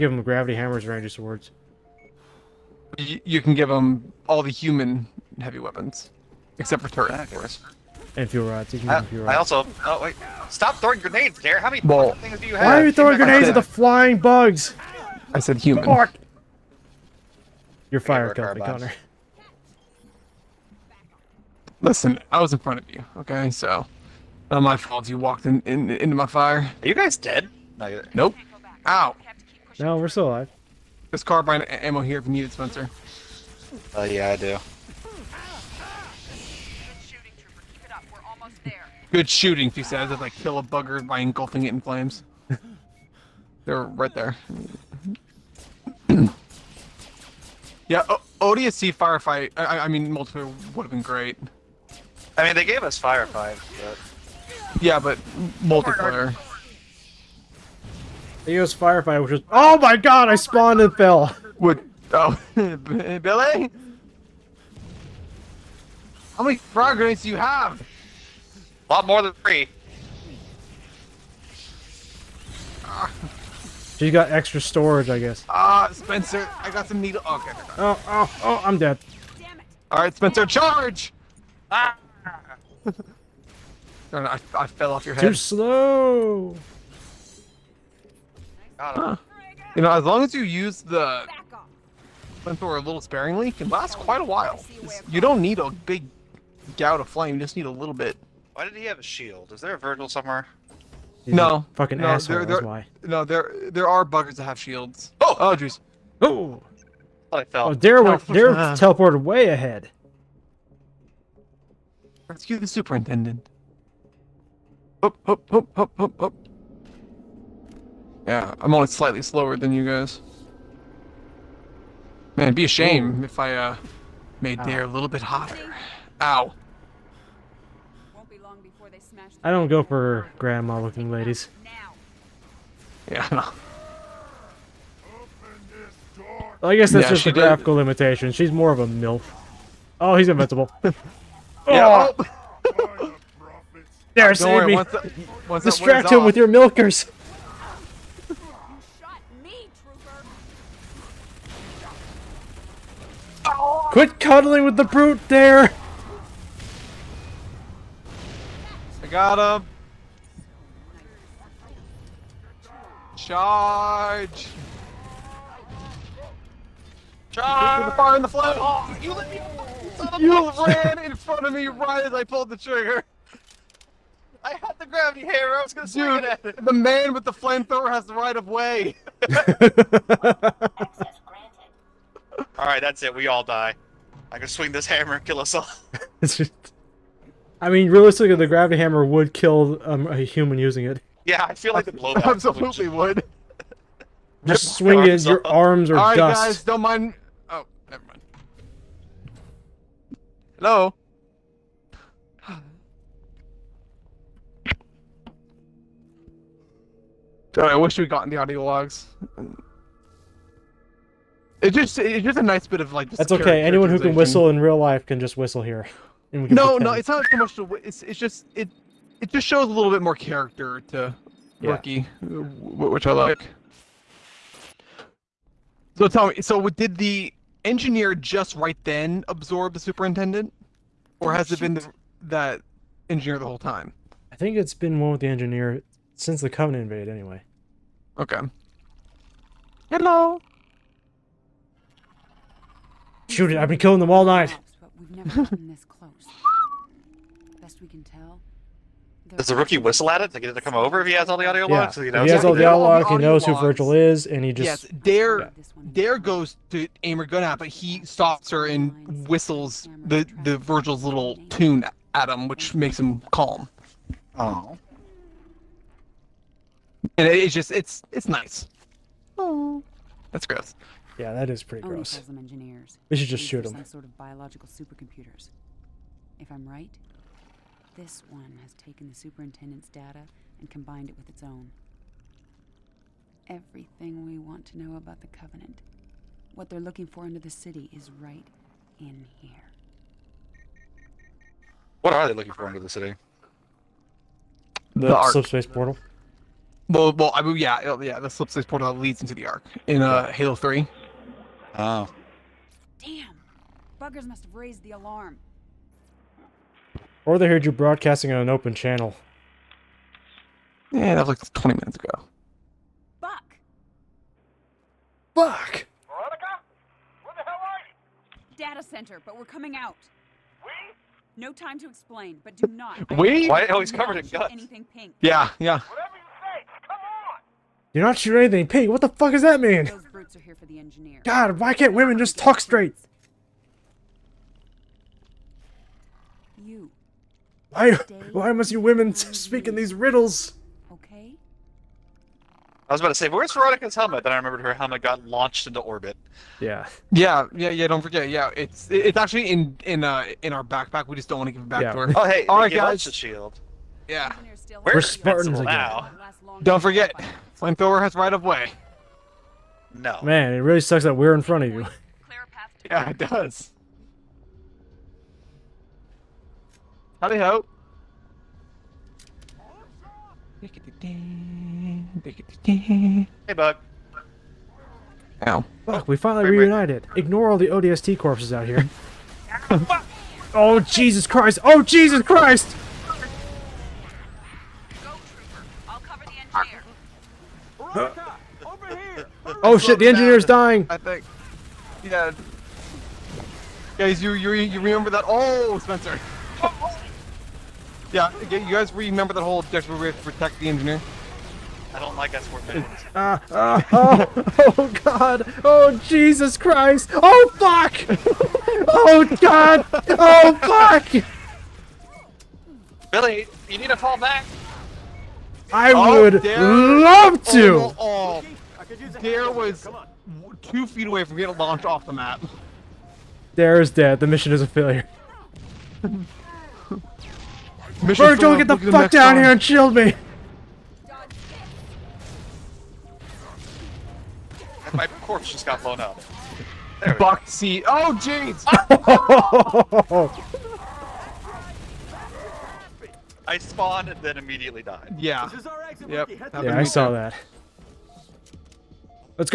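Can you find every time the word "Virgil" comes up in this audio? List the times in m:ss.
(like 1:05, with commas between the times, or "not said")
1:39, 4:13, 4:20.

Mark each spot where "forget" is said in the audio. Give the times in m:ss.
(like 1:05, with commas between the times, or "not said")
5:48, 5:56.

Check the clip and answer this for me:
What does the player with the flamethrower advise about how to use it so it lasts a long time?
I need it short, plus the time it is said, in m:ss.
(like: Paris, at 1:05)
Sparingly, at 1:33.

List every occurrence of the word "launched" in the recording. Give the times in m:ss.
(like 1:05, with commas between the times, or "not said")
5:45, 7:01.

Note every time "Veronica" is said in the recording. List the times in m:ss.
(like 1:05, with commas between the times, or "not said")
5:16, 5:43.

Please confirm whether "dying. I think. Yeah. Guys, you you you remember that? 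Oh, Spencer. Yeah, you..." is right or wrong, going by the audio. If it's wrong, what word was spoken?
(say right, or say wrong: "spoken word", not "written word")
right.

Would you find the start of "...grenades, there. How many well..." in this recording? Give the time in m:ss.
0:10.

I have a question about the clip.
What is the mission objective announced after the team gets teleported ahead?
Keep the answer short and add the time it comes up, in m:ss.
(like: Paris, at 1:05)
Rescue the superintendent, at 1:52.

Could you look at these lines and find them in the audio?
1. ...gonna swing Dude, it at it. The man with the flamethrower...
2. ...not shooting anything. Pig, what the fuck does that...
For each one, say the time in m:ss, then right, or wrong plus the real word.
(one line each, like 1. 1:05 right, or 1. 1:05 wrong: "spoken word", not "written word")
1. 2:55 right
2. 5:28 right.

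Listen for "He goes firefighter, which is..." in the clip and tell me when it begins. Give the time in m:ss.
0:58.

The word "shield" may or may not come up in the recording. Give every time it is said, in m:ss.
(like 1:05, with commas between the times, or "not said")
1:39, 1:44, 5:53, 7:09.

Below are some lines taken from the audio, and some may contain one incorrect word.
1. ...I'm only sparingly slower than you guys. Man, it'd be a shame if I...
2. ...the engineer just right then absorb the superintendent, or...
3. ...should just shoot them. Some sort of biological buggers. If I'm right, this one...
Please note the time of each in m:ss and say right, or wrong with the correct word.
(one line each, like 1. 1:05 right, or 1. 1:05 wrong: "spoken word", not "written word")
1. 1:58 wrong: "slightly", not "sparingly"
2. 3:46 right
3. 4:33 wrong: "supercomputers", not "buggers".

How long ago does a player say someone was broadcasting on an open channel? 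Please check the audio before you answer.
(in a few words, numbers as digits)
20 minutes.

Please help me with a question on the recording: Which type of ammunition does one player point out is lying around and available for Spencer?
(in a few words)
Carbine ammo.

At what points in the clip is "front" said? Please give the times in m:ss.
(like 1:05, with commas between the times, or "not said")
0:22, 2:51, 6:01.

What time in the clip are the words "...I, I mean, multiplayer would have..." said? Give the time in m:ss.
0:49.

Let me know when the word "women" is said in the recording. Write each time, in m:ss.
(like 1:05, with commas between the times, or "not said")
5:31, 5:38.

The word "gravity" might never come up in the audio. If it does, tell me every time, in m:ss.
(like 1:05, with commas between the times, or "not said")
0:00, 2:54, 3:08.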